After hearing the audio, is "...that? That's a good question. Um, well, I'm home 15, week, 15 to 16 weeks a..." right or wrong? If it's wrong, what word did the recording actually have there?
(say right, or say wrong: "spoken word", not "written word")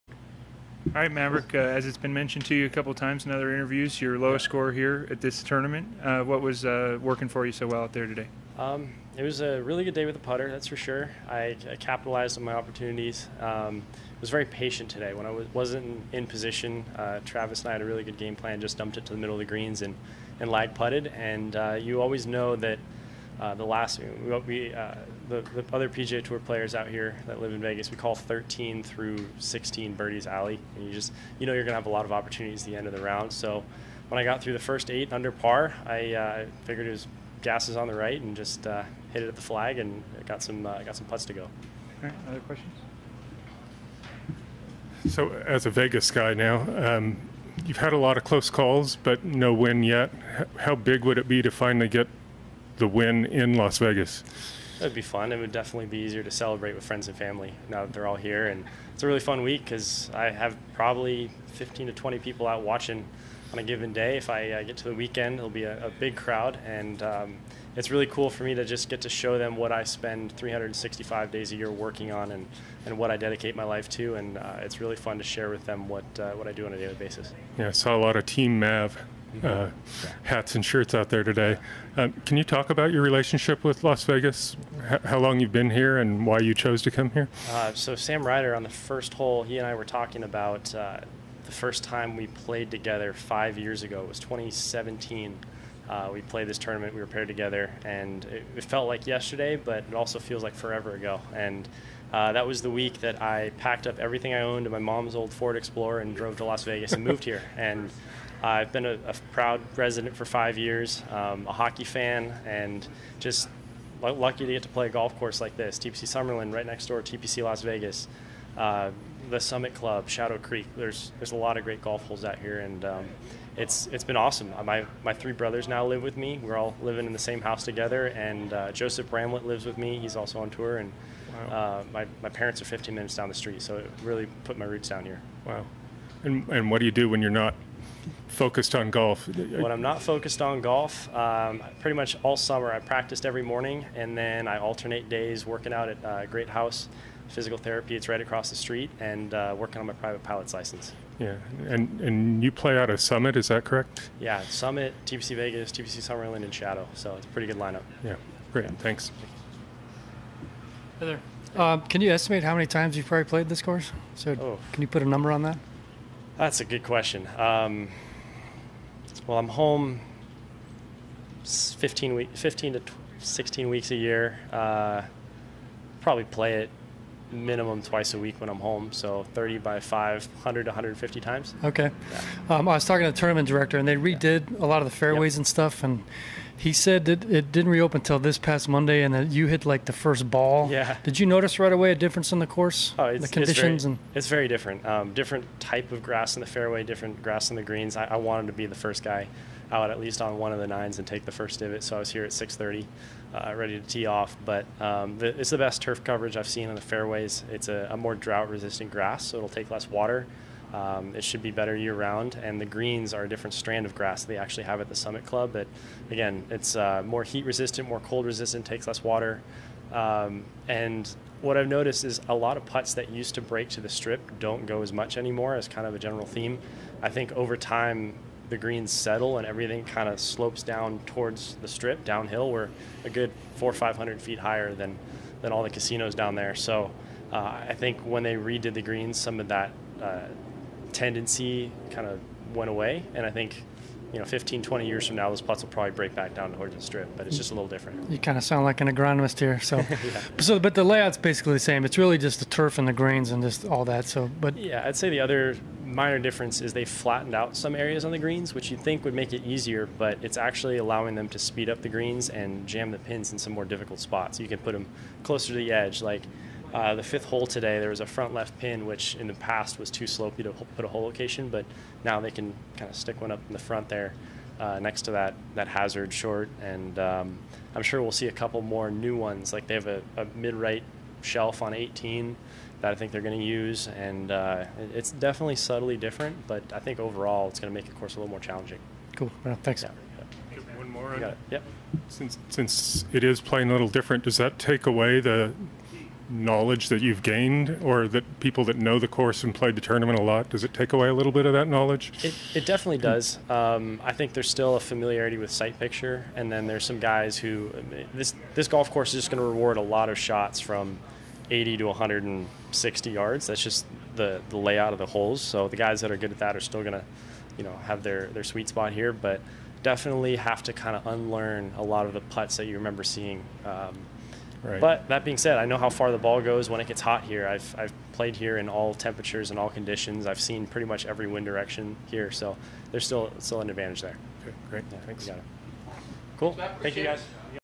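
right.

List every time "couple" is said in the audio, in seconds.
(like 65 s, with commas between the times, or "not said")
2 s, 278 s.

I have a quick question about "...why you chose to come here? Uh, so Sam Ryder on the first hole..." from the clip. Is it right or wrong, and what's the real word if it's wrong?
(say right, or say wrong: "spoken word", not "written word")
right.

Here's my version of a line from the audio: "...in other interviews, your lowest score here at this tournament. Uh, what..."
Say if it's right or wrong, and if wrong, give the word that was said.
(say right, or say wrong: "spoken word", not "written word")
right.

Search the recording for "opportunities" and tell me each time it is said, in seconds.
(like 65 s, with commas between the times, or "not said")
12 s, 32 s.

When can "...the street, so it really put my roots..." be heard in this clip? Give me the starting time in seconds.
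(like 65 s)
133 s.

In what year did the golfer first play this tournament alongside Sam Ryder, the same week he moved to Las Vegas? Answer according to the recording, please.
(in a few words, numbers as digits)
2017.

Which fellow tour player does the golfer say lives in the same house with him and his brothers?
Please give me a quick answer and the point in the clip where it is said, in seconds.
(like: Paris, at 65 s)
Joseph Bramlett, at 128 s.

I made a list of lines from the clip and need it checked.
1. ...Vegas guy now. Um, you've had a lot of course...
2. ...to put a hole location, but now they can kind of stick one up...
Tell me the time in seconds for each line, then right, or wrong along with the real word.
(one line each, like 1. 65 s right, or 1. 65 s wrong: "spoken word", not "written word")
1. 45 s wrong: "close", not "course"
2. 270 s right.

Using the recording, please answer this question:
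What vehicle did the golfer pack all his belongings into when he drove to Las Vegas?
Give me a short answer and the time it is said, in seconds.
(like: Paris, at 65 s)
Ford Explorer, at 105 s.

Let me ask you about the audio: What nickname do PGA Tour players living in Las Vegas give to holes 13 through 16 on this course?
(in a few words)
birdies alley.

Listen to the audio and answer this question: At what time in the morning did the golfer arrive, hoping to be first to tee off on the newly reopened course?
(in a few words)
6:30.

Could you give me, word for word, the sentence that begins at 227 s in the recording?
I think over time, the greens settle and everything kind of slopes down towards the strip downhill.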